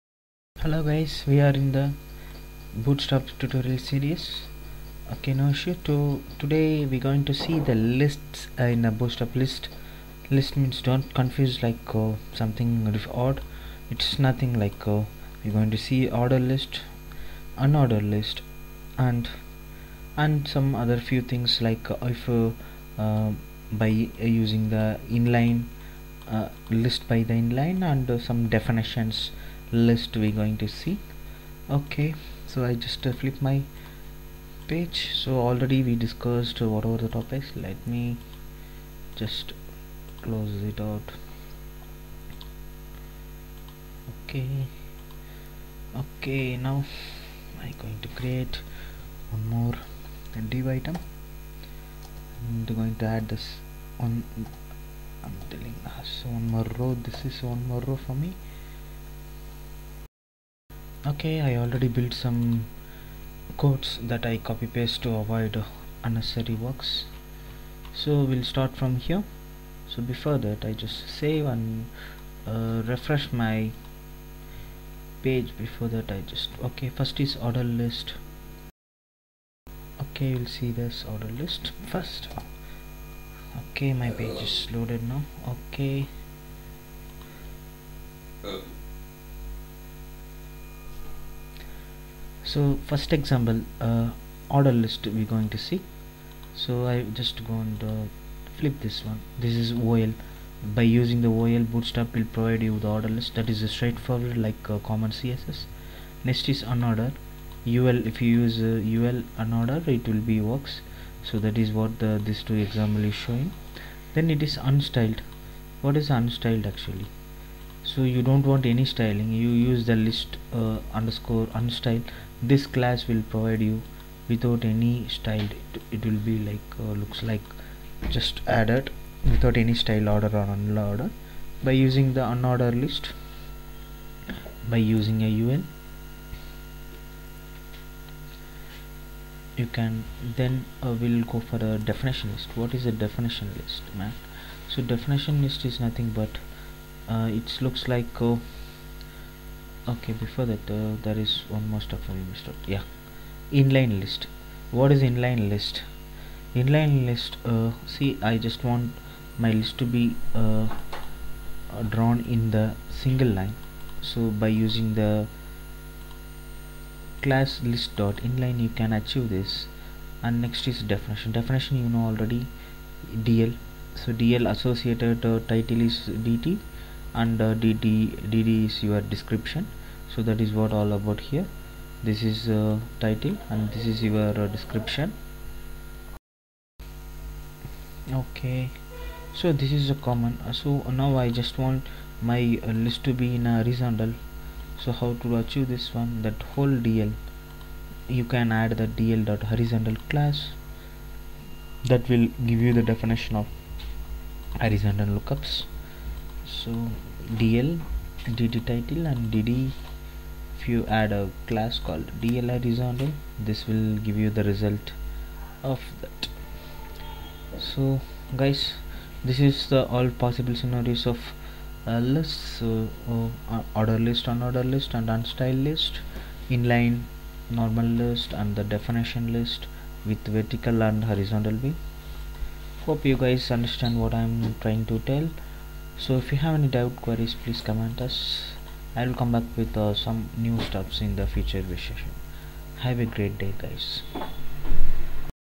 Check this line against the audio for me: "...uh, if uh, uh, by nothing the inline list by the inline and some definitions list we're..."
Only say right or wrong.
wrong.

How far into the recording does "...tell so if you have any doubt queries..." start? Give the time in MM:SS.
03:55.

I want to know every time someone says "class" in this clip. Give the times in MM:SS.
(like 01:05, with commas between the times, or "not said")
02:02, 02:47, 03:20, 03:31.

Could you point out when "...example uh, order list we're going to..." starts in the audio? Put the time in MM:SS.
01:33.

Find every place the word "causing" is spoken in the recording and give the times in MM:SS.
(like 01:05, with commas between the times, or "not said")
not said.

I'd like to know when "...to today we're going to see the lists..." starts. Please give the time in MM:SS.
00:05.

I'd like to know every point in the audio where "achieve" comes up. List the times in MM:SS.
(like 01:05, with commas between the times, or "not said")
02:48, 03:15.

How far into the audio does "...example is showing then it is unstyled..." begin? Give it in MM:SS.
01:52.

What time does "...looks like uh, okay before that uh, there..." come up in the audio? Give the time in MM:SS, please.
02:27.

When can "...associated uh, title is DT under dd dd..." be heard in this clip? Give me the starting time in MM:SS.
02:54.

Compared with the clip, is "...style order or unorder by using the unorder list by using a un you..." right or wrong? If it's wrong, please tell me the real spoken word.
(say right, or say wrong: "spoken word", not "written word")
right.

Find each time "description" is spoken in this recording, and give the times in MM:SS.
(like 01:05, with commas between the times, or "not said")
02:59, 03:04.